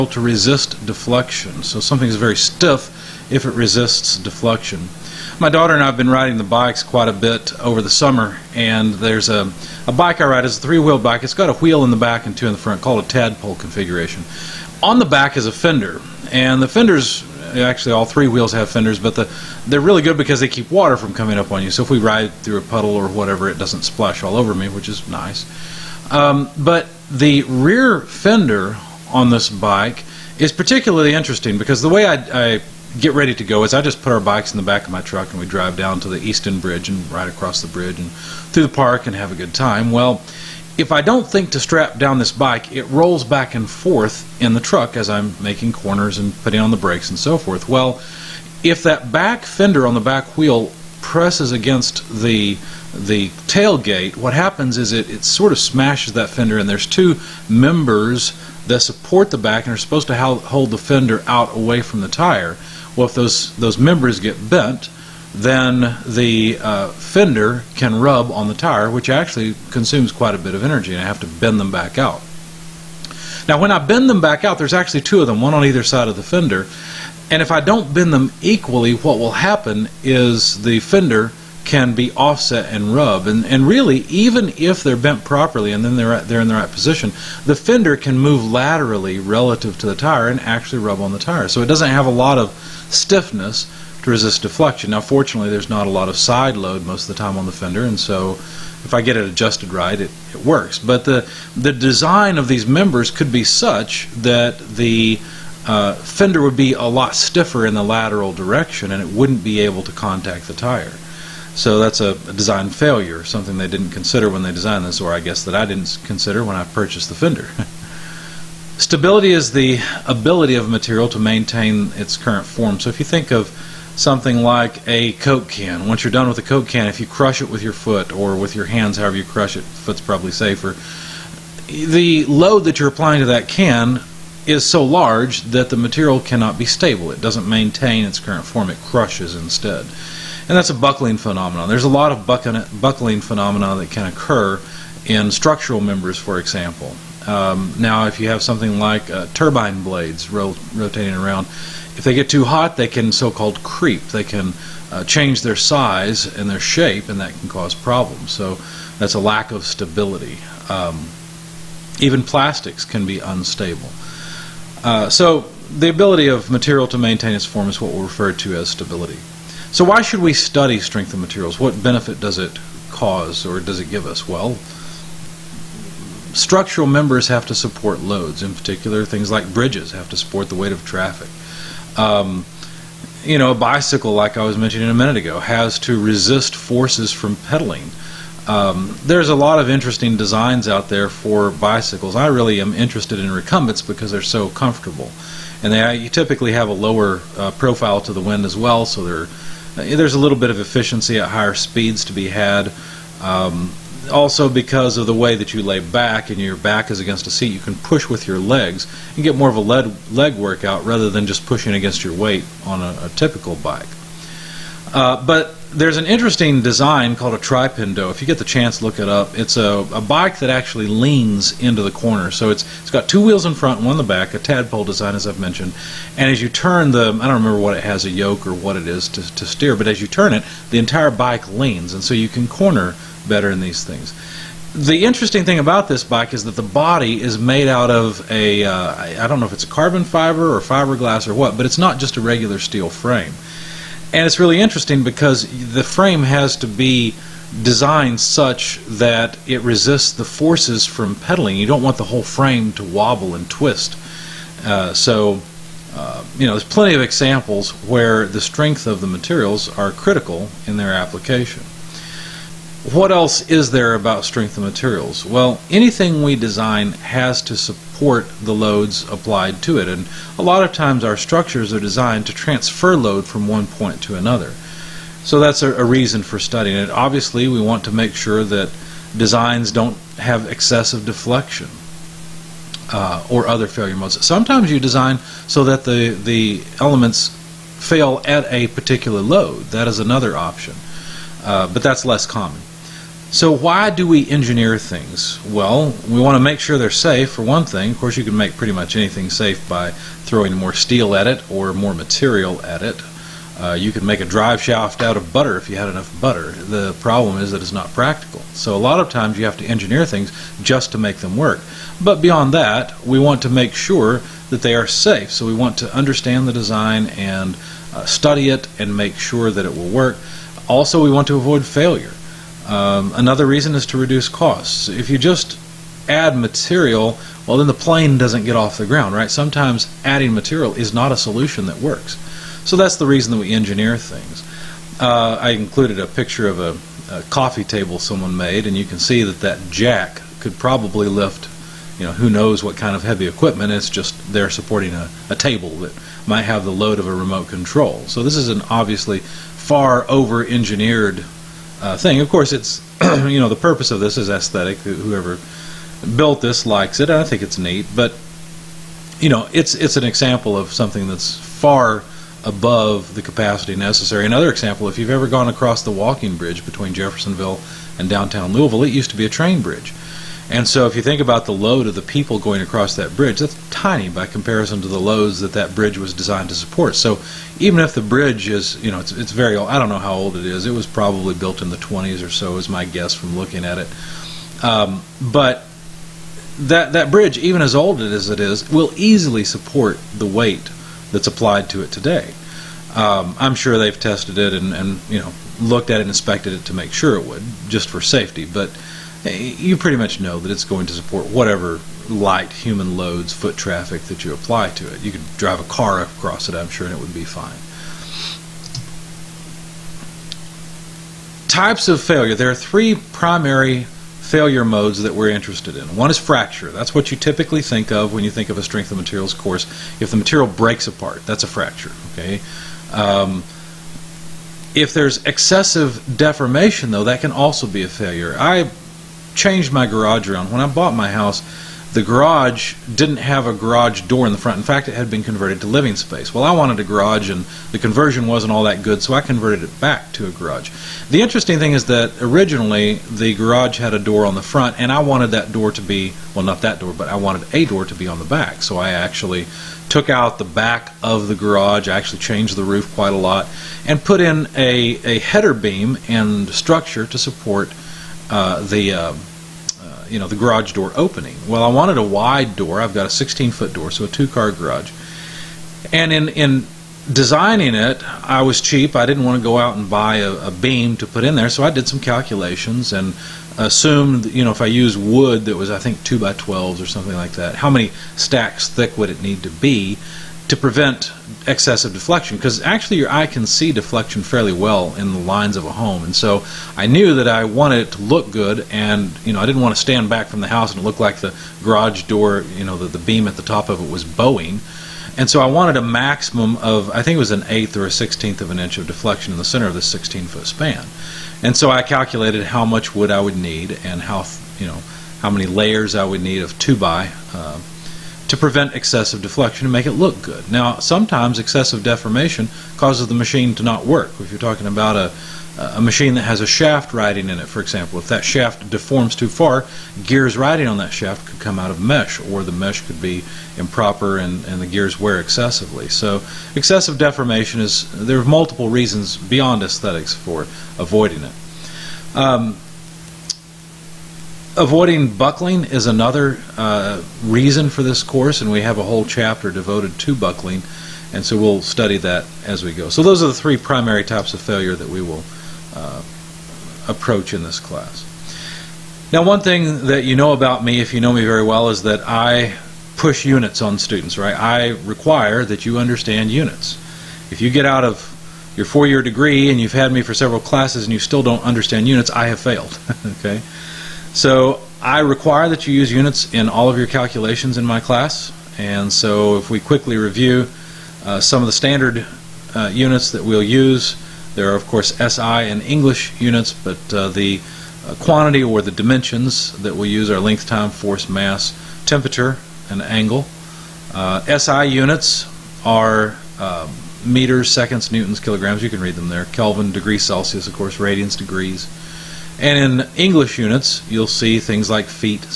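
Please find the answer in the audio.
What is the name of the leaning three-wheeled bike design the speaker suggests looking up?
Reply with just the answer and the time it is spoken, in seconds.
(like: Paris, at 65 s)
Tripendo, at 217 s.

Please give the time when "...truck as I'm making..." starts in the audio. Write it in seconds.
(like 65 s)
44 s.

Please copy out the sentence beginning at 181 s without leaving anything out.
Um, you know, a bicycle, like I was mentioning a minute ago, has to resist forces from pedaling.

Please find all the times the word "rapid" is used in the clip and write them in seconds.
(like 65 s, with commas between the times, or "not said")
not said.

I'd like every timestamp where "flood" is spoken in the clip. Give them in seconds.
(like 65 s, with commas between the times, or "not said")
not said.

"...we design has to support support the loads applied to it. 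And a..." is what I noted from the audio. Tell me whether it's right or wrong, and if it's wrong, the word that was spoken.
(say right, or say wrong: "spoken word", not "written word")
right.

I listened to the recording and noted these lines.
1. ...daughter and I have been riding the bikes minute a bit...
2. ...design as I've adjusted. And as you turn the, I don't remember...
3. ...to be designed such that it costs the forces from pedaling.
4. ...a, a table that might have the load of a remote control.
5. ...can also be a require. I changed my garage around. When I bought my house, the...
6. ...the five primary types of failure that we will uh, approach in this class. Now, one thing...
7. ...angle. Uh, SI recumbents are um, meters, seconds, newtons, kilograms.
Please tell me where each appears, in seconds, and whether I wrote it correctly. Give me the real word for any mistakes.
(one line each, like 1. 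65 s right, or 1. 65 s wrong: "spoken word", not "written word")
1. 5 s wrong: "quite", not "minute"
2. 224 s wrong: "mentioned", not "adjusted"
3. 246 s wrong: "resists", not "costs"
4. 344 s right
5. 427 s wrong: "failure", not "require"
6. 543 s wrong: "three", not "five"
7. 582 s wrong: "units", not "recumbents".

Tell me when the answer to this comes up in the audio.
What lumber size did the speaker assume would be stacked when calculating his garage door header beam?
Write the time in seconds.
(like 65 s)
476 s.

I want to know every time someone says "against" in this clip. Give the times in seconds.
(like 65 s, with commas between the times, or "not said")
51 s, 206 s, 211 s.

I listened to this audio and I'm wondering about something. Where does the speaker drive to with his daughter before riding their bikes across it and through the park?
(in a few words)
Easton Bridge.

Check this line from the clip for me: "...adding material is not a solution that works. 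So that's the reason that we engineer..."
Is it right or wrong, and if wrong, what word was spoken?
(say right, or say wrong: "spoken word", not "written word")
right.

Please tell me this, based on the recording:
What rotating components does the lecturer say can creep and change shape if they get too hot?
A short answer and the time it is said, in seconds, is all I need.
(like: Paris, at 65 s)
turbine blades, at 149 s.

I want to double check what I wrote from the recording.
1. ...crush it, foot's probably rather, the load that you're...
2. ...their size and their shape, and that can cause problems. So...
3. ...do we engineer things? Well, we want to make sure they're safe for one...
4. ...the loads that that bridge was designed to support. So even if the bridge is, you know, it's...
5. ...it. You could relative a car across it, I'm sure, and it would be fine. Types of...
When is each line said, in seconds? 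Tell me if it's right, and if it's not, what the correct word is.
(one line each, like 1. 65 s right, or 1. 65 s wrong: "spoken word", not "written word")
1. 129 s wrong: "safer", not "rather"
2. 155 s right
3. 293 s right
4. 374 s right
5. 404 s wrong: "drive", not "relative".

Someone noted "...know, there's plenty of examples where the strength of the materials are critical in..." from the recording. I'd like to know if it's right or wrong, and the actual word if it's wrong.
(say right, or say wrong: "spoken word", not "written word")
right.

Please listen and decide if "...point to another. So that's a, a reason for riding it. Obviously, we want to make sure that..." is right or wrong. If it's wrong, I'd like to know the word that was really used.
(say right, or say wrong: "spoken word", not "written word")
wrong: "studying", not "riding".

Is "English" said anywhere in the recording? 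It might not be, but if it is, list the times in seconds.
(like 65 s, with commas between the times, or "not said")
575 s, 592 s.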